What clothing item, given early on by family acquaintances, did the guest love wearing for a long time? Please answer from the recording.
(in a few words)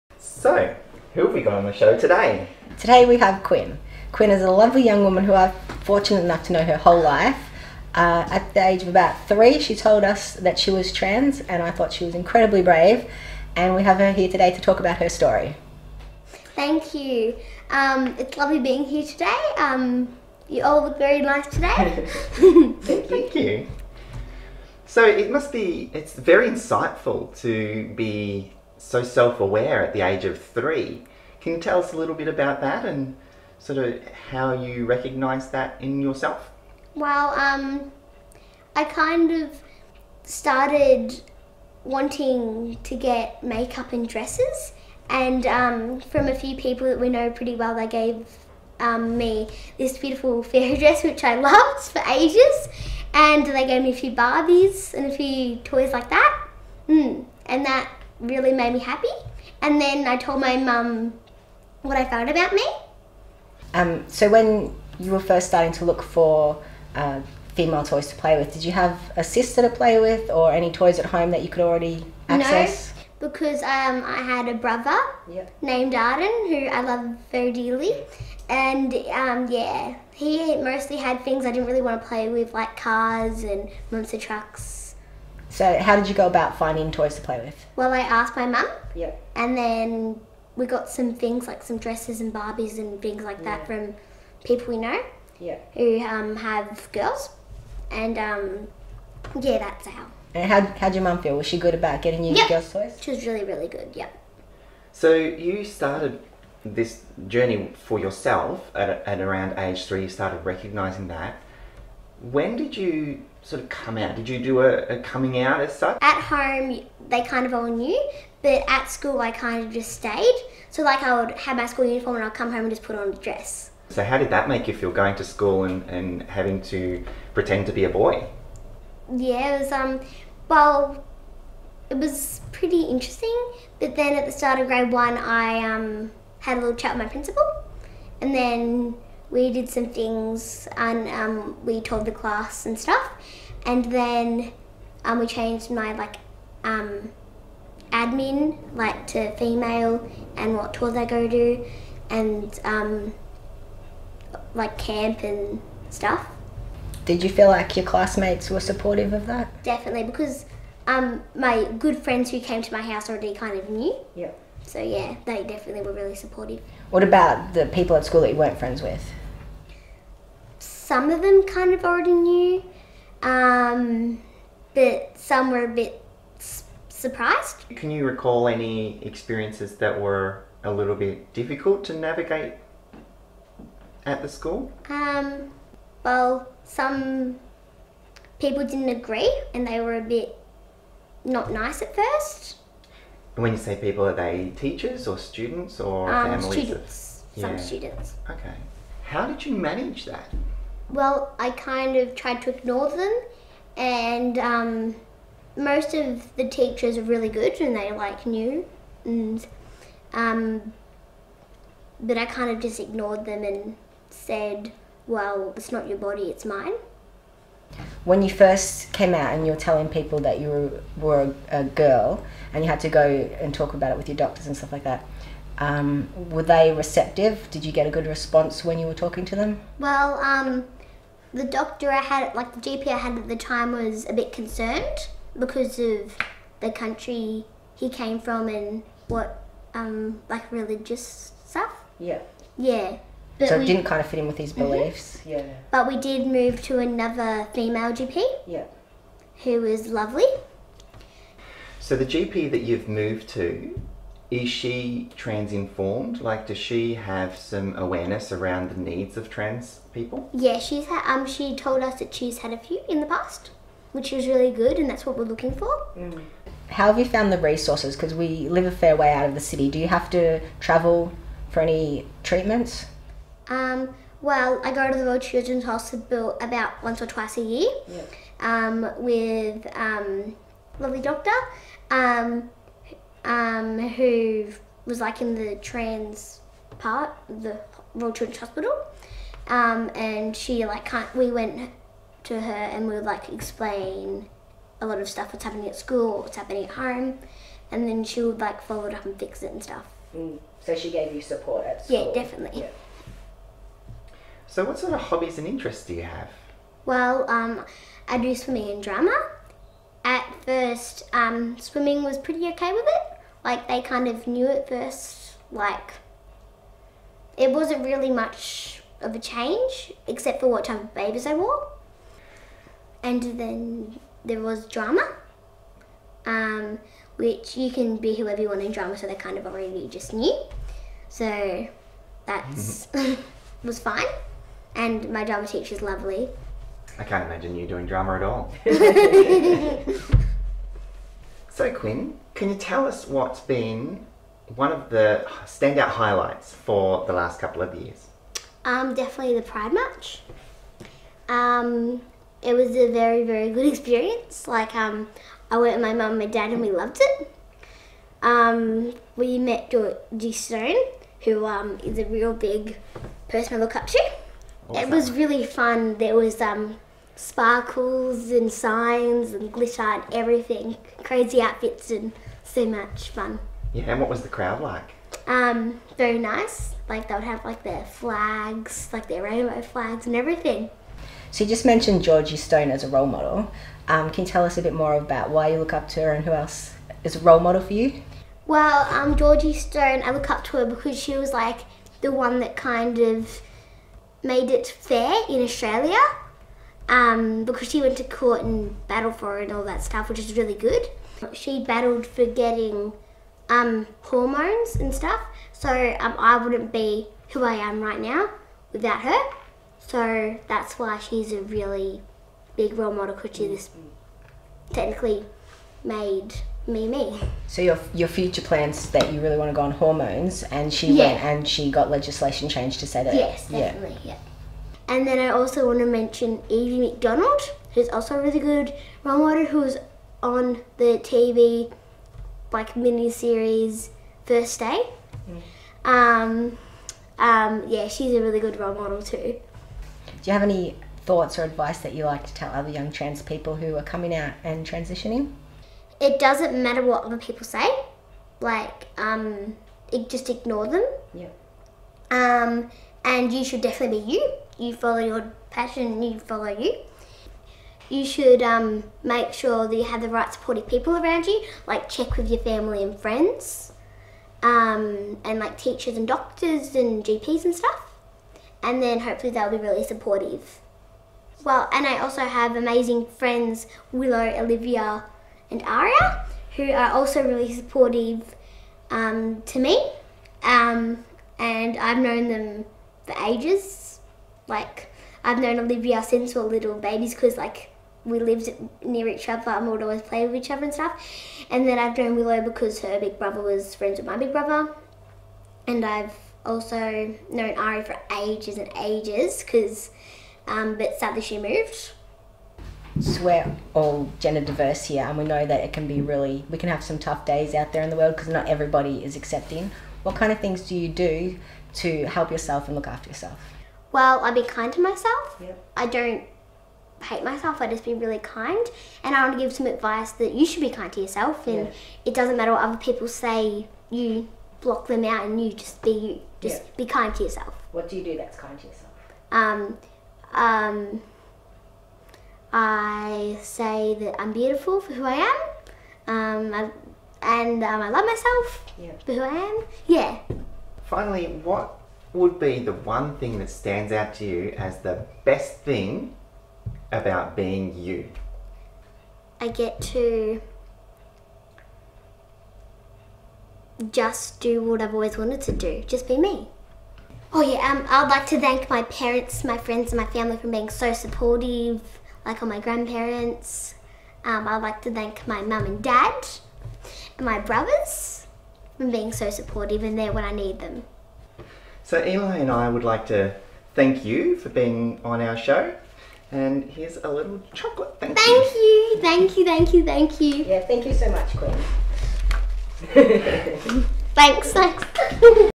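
Fairy dress.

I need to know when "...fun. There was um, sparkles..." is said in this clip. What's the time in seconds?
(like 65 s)
365 s.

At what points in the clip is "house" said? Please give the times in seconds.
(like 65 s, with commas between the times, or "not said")
162 s.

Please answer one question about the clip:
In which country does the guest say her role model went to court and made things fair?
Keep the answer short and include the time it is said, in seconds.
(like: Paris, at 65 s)
Australia, at 395 s.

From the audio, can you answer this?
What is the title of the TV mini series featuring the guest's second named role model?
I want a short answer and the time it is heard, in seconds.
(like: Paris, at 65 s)
First Day, at 434 s.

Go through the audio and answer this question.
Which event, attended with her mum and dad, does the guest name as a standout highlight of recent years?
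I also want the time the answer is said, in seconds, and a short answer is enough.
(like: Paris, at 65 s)
Pride March, at 349 s.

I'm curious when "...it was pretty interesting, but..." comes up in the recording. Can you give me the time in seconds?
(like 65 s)
131 s.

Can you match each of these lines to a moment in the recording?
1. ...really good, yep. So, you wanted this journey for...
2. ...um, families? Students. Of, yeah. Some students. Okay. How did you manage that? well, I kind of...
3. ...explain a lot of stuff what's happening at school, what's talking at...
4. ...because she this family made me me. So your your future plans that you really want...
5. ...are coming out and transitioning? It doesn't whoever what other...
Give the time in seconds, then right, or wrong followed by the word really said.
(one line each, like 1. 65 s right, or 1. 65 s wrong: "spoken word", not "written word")
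1. 103 s wrong: "started", not "wanted"
2. 196 s right
3. 293 s wrong: "happening", not "talking"
4. 413 s wrong: "technically", not "family"
5. 443 s wrong: "matter", not "whoever".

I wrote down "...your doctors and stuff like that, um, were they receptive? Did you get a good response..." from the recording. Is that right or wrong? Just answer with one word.
right.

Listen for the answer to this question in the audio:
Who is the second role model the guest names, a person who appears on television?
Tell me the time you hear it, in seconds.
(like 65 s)
426 s.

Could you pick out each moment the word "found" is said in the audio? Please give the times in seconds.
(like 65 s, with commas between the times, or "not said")
62 s, 267 s.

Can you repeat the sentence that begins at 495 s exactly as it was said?
And I've also known Ari for ages and ages because, um, but sadly she moved.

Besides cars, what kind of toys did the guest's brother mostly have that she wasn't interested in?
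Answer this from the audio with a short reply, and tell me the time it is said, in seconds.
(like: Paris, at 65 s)
Monster trucks, at 83 s.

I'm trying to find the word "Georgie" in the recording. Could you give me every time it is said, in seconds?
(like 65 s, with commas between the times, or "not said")
359 s, 382 s, 389 s.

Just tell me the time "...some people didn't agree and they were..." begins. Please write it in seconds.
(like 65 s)
186 s.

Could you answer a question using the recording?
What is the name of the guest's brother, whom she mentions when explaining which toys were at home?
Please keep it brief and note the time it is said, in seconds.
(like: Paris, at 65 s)
Arden, at 75 s.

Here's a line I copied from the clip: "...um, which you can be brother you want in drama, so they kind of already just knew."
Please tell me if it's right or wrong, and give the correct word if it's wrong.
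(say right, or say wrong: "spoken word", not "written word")
wrong: "whoever", not "brother".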